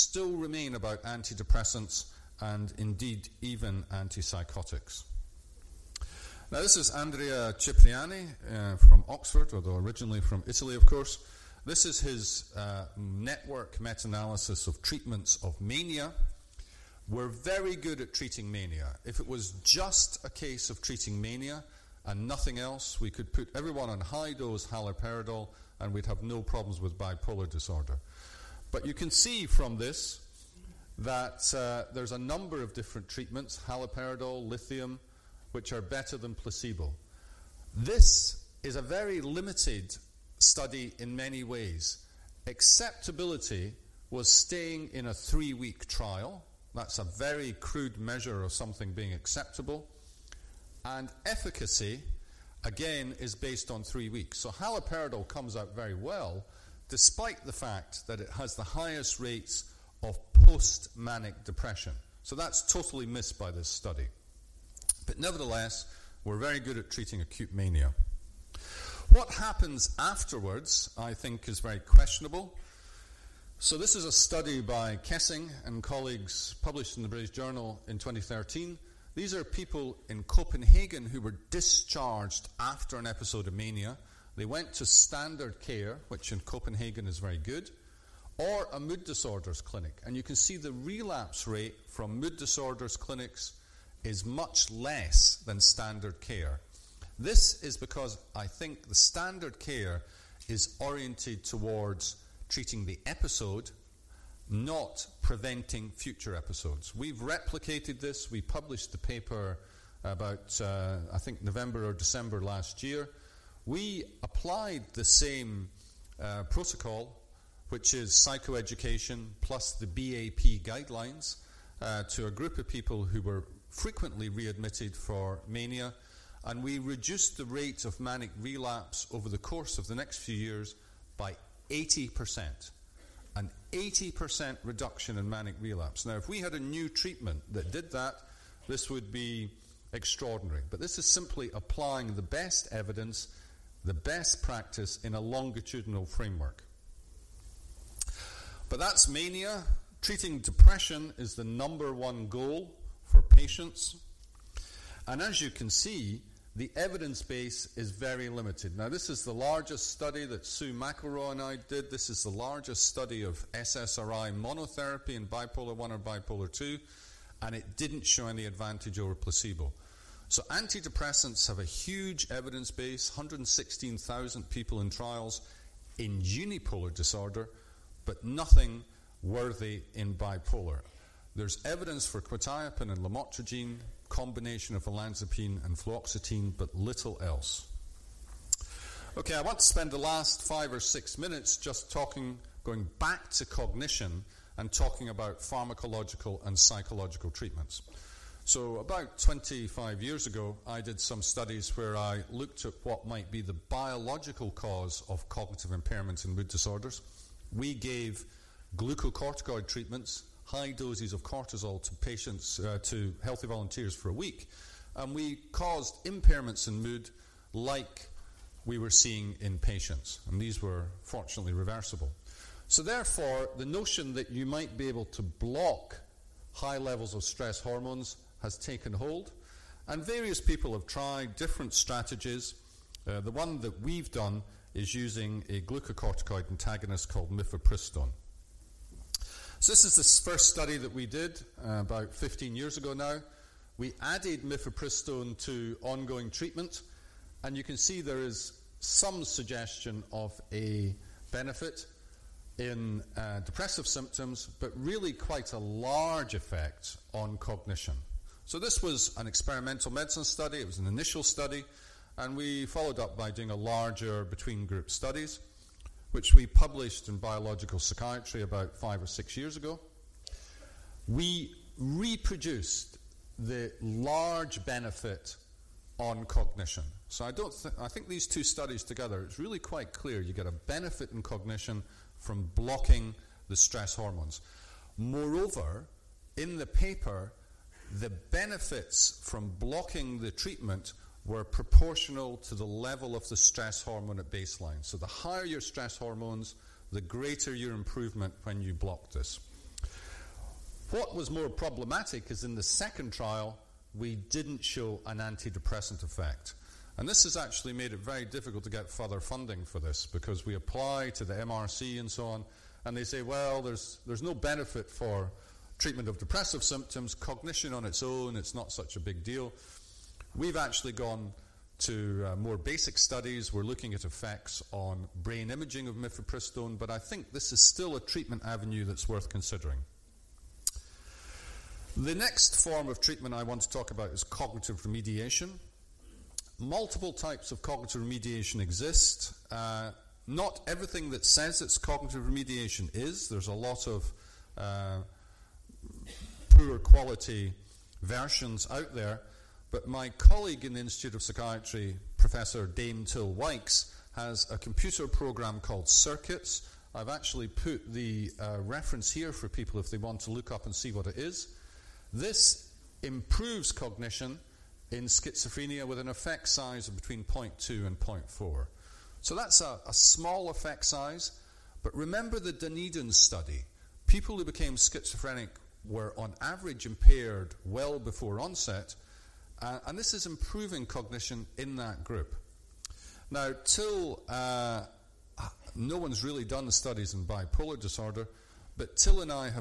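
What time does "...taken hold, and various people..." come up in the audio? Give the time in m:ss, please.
3:48.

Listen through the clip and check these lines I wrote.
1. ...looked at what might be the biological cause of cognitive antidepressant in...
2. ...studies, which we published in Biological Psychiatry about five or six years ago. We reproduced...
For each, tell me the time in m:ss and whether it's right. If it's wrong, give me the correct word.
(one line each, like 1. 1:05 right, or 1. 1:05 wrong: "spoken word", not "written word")
1. 3:22 wrong: "impairment", not "antidepressant"
2. 4:24 right.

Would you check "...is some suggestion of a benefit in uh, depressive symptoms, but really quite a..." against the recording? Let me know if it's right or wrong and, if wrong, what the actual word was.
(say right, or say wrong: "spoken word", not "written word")
right.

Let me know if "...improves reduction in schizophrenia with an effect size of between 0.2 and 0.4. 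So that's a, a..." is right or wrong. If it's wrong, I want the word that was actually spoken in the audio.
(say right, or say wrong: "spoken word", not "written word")
wrong: "cognition", not "reduction".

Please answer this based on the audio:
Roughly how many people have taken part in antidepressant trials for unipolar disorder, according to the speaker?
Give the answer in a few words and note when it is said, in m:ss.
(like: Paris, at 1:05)
116,000, at 2:53.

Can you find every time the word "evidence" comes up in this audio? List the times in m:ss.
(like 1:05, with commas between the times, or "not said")
2:22, 2:36, 2:52, 3:01.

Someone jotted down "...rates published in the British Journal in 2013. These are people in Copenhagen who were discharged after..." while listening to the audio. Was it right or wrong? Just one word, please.
wrong.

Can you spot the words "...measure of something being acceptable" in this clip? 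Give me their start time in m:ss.
0:47.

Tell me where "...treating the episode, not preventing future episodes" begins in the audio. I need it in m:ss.
1:42.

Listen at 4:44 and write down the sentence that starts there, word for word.
Moreover, in the paper, the benefits from blocking the treatment were proportional to the level of the stress hormone at baseline.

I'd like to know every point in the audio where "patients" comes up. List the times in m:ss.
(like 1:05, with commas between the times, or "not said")
2:33, 3:31, 3:39.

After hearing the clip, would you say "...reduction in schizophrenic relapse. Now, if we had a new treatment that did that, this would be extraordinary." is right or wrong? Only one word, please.
wrong.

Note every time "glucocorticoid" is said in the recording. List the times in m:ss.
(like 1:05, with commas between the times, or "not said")
3:28, 3:55.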